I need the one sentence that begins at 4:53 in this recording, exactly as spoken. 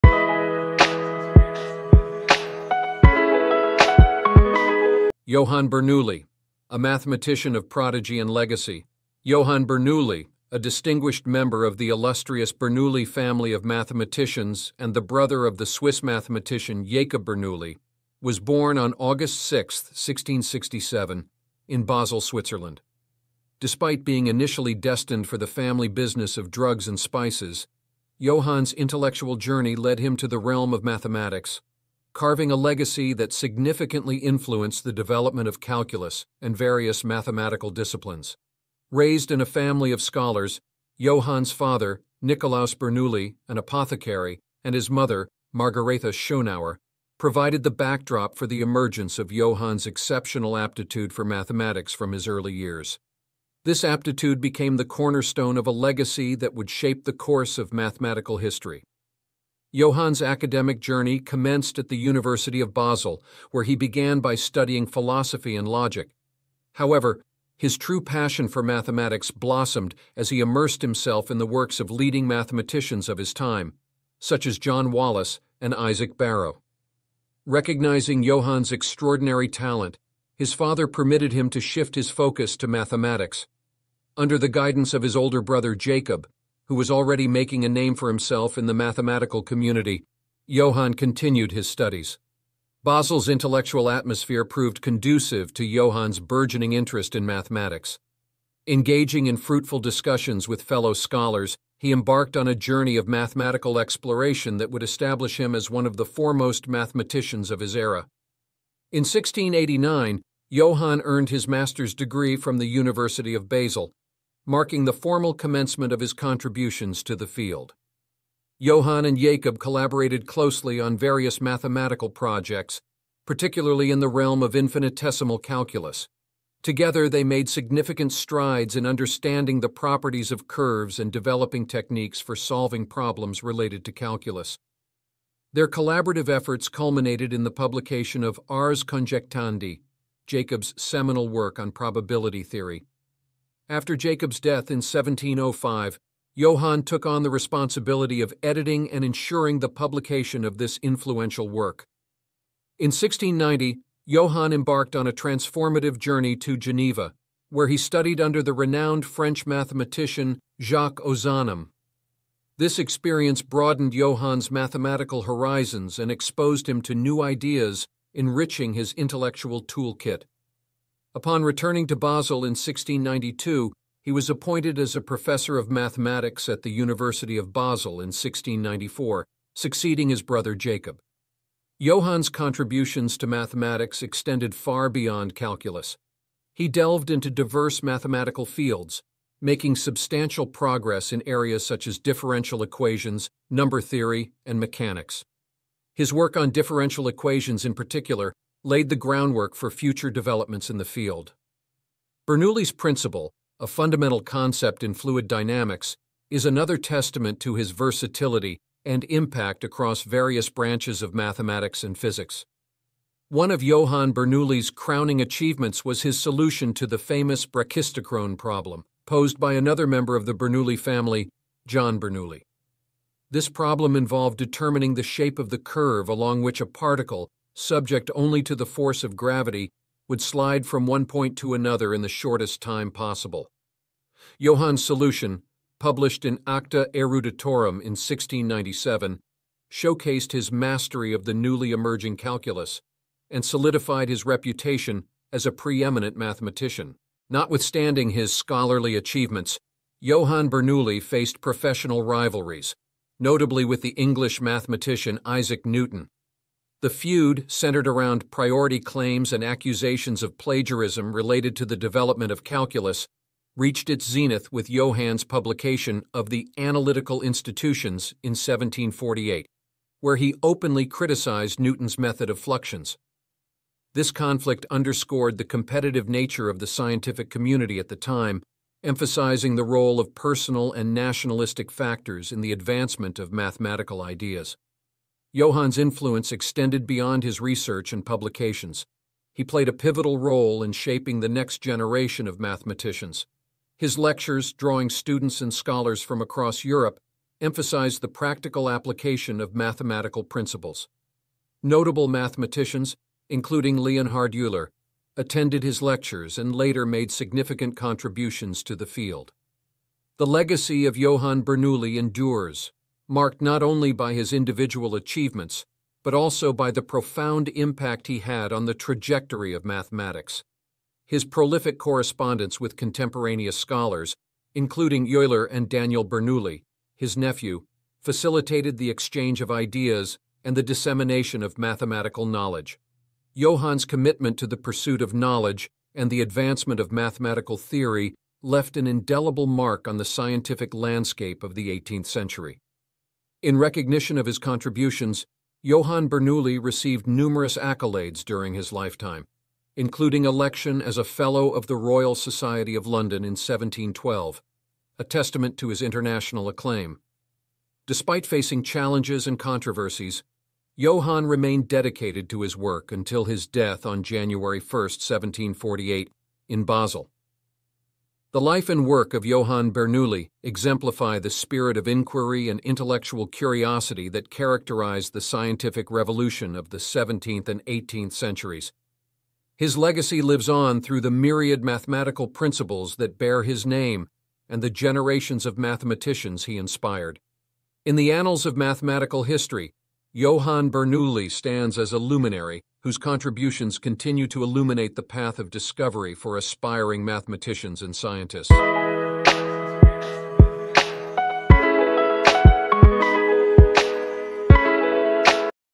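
His lectures, drawing students and scholars from across Europe, emphasized the practical application of mathematical principles.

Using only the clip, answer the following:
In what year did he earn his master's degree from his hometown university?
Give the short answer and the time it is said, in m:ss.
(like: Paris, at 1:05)
1689, at 1:49.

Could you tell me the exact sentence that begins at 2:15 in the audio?
Their collaborative efforts culminated in the publication of Ars Conjectandi, Jacob's seminal work on probability theory.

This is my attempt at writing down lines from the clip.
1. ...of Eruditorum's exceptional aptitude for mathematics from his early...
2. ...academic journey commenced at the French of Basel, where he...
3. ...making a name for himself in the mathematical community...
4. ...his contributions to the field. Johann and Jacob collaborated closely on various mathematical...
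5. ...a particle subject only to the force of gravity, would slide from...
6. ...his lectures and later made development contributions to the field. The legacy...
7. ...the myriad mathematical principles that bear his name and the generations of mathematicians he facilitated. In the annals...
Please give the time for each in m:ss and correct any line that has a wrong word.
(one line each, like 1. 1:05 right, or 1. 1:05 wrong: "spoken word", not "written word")
1. 0:49 wrong: "Johann", not "Eruditorum"
2. 1:00 wrong: "University", not "French"
3. 1:27 right
4. 1:55 right
5. 3:46 right
6. 5:05 wrong: "significant", not "development"
7. 6:21 wrong: "inspired", not "facilitated".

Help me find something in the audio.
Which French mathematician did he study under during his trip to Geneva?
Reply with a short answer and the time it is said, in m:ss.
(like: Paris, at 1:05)
Jacques Ozanam, at 2:40.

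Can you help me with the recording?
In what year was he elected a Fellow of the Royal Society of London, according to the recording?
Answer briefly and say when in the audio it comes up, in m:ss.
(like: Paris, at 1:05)
1712, at 5:53.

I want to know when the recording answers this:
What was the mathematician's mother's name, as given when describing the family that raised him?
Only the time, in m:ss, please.
0:45.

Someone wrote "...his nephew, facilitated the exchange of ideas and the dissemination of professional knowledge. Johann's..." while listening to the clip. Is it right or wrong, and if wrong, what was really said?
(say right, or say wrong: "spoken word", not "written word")
wrong: "mathematical", not "professional".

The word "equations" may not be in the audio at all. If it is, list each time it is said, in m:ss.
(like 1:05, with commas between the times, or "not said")
3:12, 3:17.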